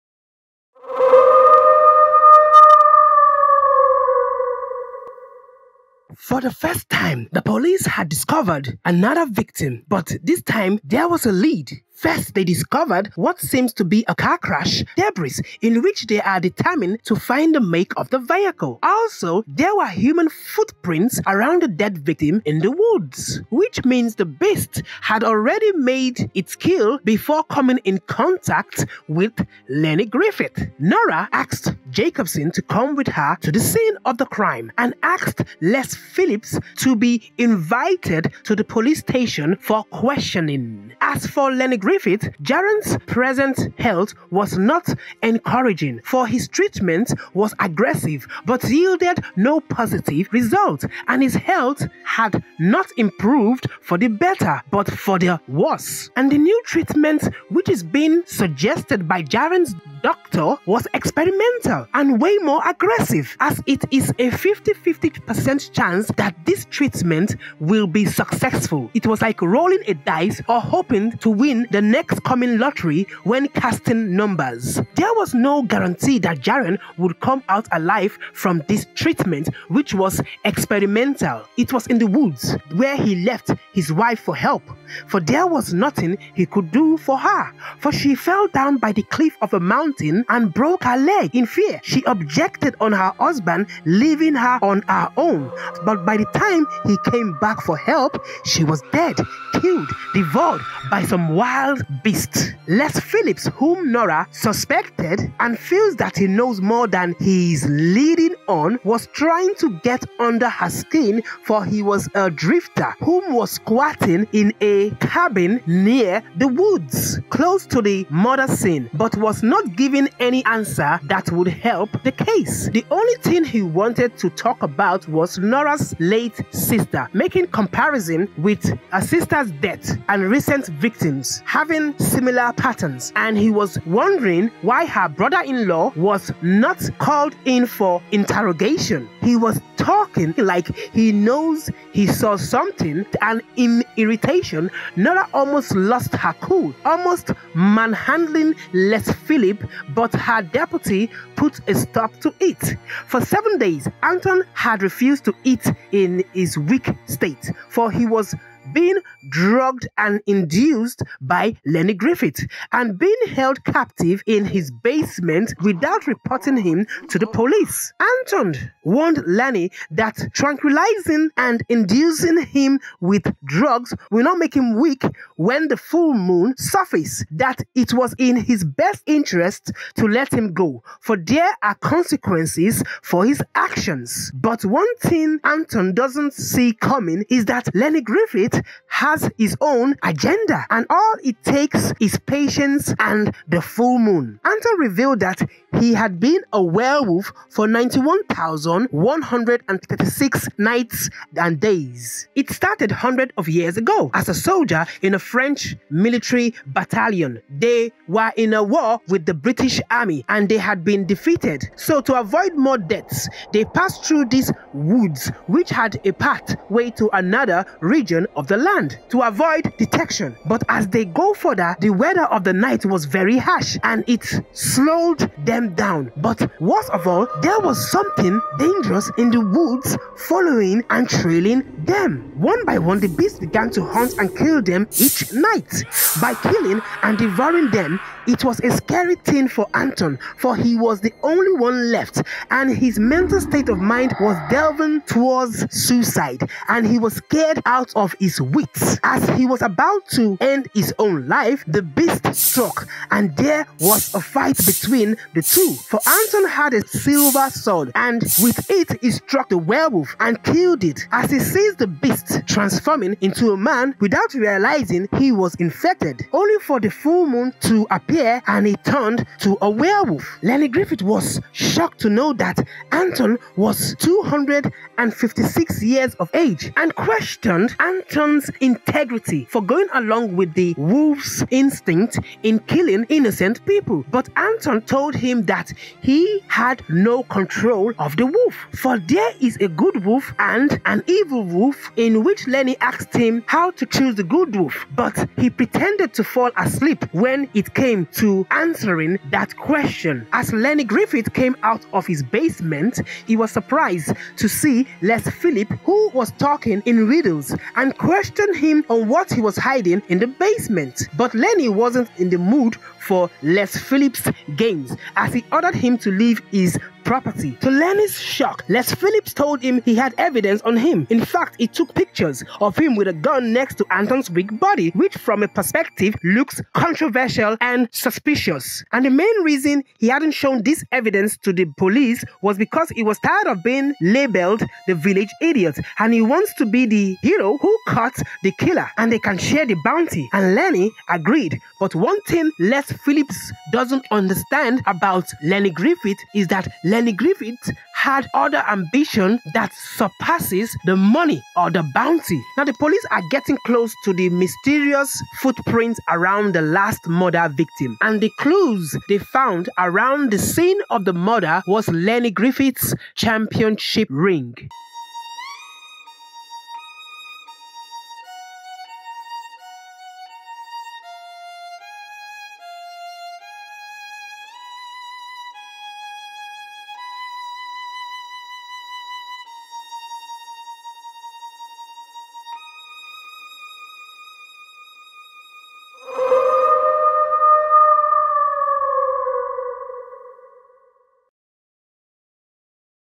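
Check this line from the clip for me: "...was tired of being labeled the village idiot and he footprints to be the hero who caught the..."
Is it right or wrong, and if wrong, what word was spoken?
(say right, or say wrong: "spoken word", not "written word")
wrong: "wants", not "footprints".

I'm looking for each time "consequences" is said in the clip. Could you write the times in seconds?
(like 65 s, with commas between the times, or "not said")
181 s.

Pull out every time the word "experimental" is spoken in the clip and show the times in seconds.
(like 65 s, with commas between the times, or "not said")
60 s, 80 s.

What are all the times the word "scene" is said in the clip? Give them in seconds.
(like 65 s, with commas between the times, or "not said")
33 s, 118 s, 360 s.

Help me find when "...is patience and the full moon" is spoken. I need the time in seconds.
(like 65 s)
191 s.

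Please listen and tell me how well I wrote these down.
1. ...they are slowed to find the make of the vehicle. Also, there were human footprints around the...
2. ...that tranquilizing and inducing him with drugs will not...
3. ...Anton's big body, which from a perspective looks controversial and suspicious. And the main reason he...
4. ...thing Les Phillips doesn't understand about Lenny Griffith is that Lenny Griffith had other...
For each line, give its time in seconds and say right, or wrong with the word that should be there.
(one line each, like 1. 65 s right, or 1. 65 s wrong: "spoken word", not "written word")
1. 16 s wrong: "determined", not "slowed"
2. 169 s right
3. 323 s right
4. 342 s right.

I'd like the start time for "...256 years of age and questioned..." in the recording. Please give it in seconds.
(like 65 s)
273 s.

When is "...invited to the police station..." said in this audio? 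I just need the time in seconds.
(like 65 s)
37 s.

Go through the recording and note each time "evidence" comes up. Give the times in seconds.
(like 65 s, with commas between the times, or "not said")
320 s, 330 s.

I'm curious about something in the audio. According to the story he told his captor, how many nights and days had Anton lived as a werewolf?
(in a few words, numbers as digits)
91,136.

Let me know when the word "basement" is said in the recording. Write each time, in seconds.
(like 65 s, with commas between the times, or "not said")
164 s, 302 s, 310 s.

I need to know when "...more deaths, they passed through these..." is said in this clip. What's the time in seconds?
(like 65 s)
212 s.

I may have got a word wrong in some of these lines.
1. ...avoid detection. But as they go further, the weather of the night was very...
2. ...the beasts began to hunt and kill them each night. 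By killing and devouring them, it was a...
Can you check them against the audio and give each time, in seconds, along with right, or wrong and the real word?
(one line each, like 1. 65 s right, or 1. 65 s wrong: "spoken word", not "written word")
1. 219 s right
2. 232 s right.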